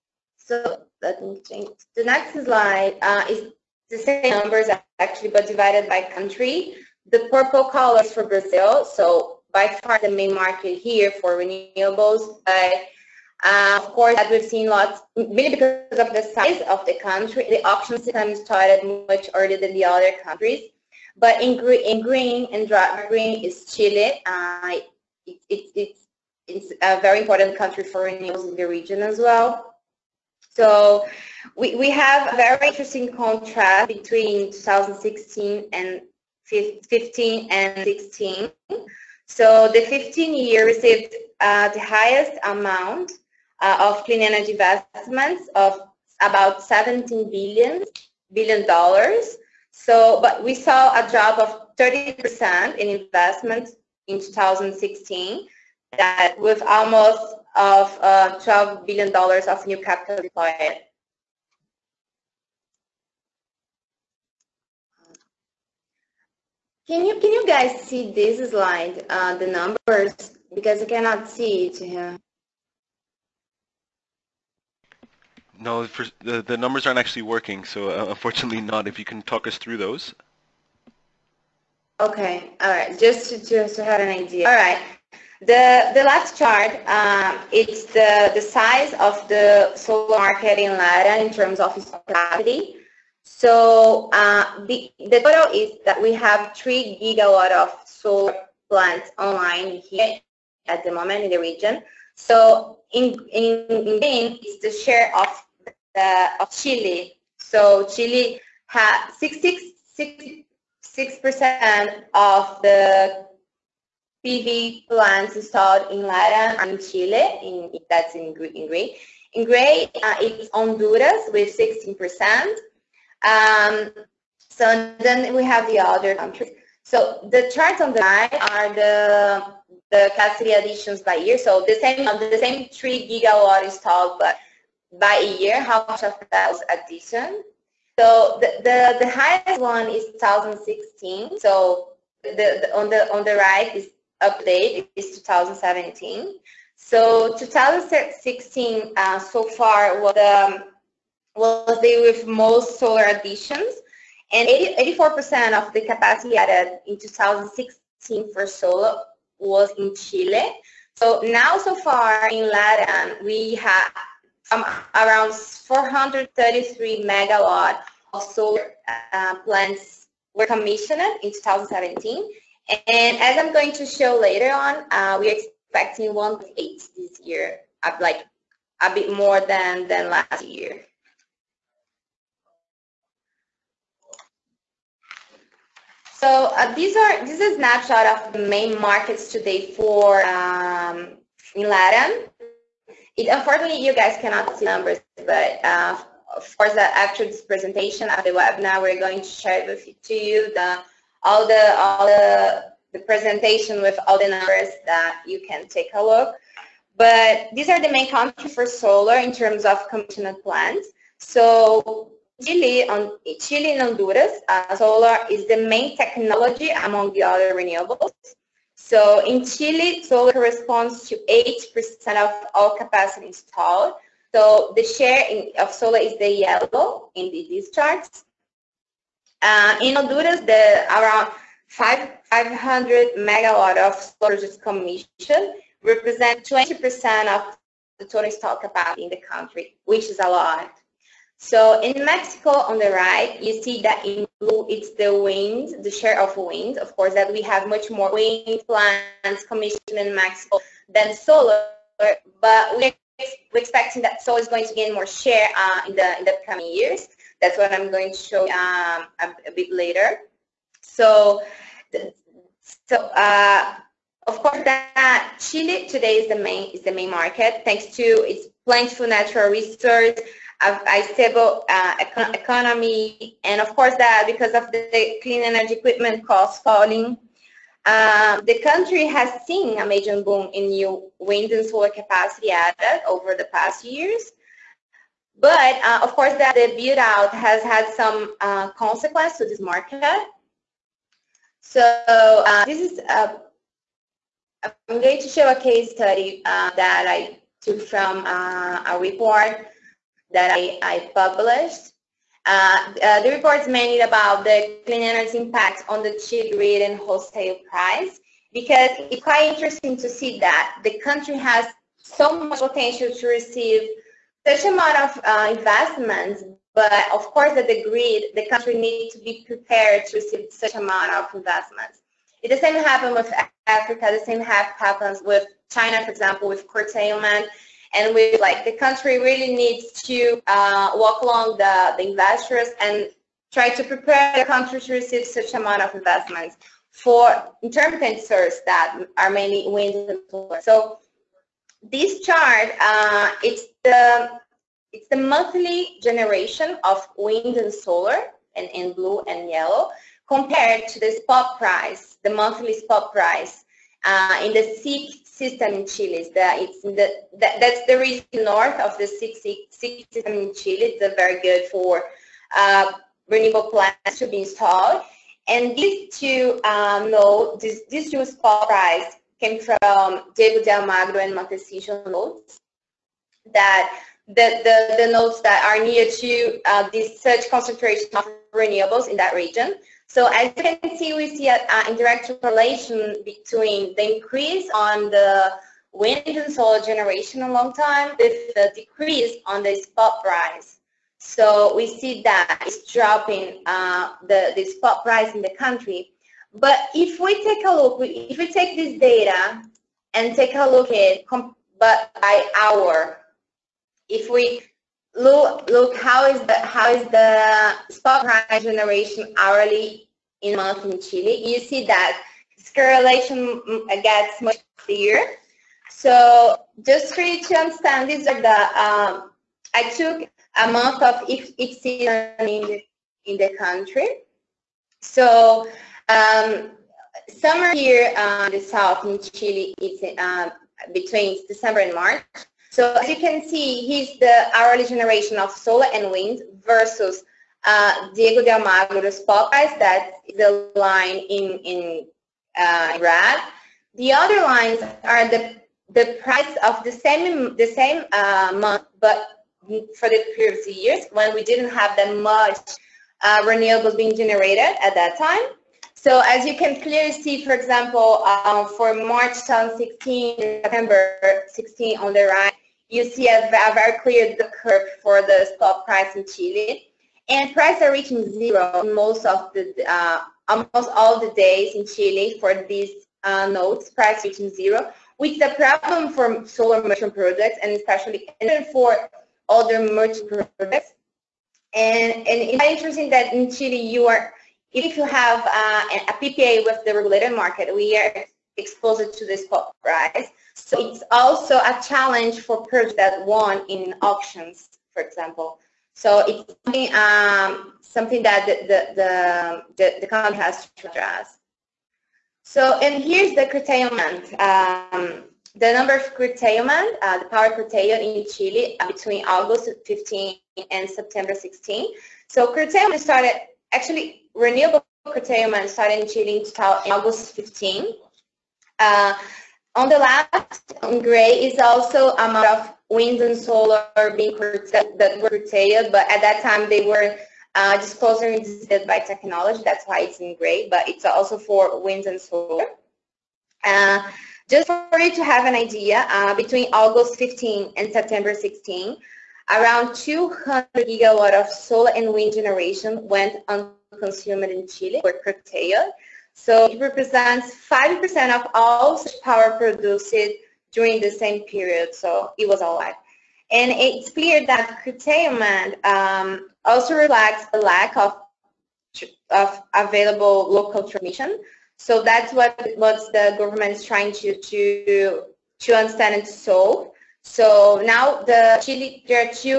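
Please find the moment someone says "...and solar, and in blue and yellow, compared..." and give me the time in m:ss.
5:47.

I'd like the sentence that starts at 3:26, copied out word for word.
But these are the main countries for solar in terms of commissioned plants.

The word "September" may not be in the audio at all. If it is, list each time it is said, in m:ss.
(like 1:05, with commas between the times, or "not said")
7:40, 8:30, 8:57.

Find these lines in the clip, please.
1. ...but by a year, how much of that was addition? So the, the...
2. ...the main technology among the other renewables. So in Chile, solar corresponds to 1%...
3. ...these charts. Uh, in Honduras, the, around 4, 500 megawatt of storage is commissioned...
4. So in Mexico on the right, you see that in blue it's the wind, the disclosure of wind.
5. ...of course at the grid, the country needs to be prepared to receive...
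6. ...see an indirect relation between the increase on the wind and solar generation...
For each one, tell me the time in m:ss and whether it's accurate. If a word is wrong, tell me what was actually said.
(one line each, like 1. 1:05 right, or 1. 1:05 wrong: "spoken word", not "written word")
1. 2:14 right
2. 3:35 wrong: "8", not "1"
3. 3:47 wrong: "5", not "4"
4. 4:01 wrong: "share", not "disclosure"
5. 5:17 right
6. 6:21 right.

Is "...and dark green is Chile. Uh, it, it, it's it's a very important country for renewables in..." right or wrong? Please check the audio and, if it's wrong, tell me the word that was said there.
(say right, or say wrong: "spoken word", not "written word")
right.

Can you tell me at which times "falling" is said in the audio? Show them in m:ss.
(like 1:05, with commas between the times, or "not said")
4:36.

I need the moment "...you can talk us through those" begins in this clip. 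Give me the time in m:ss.
1:18.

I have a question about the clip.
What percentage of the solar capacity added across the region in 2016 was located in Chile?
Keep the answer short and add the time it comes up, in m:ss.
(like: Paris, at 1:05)
84%, at 2:34.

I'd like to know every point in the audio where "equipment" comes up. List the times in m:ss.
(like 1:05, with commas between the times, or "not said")
4:35.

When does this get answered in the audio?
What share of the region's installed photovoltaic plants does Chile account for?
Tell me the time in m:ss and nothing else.
1:49.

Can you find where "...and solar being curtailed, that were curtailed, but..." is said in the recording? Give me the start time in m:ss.
8:43.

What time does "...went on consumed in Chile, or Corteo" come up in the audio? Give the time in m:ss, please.
9:03.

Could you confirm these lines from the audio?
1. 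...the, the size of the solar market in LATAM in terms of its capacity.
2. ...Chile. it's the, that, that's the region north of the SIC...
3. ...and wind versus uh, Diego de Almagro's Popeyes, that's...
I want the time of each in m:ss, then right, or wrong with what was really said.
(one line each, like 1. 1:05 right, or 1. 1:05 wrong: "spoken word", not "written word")
1. 1:27 right
2. 5:55 right
3. 7:15 right.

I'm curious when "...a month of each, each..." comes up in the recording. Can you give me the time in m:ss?
7:00.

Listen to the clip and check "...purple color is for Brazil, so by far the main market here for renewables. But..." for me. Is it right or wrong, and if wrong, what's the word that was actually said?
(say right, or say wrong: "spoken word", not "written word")
right.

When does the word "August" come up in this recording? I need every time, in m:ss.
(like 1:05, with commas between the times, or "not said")
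8:29, 8:36, 8:56.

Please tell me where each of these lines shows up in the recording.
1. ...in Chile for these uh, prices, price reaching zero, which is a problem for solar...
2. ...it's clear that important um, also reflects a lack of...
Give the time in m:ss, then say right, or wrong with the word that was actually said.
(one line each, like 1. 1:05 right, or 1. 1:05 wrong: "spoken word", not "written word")
1. 7:51 wrong: "notes", not "prices"
2. 9:13 wrong: "curtailment", not "important".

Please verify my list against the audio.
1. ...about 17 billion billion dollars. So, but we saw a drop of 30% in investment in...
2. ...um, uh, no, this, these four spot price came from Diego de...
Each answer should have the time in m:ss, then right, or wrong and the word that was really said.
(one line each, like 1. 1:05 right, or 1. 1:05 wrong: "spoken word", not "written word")
1. 0:46 right
2. 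6:06 wrong: "two", not "four".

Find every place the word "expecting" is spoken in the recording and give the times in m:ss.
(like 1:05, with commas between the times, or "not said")
2:55, 4:13.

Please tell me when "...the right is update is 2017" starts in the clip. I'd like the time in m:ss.
2:23.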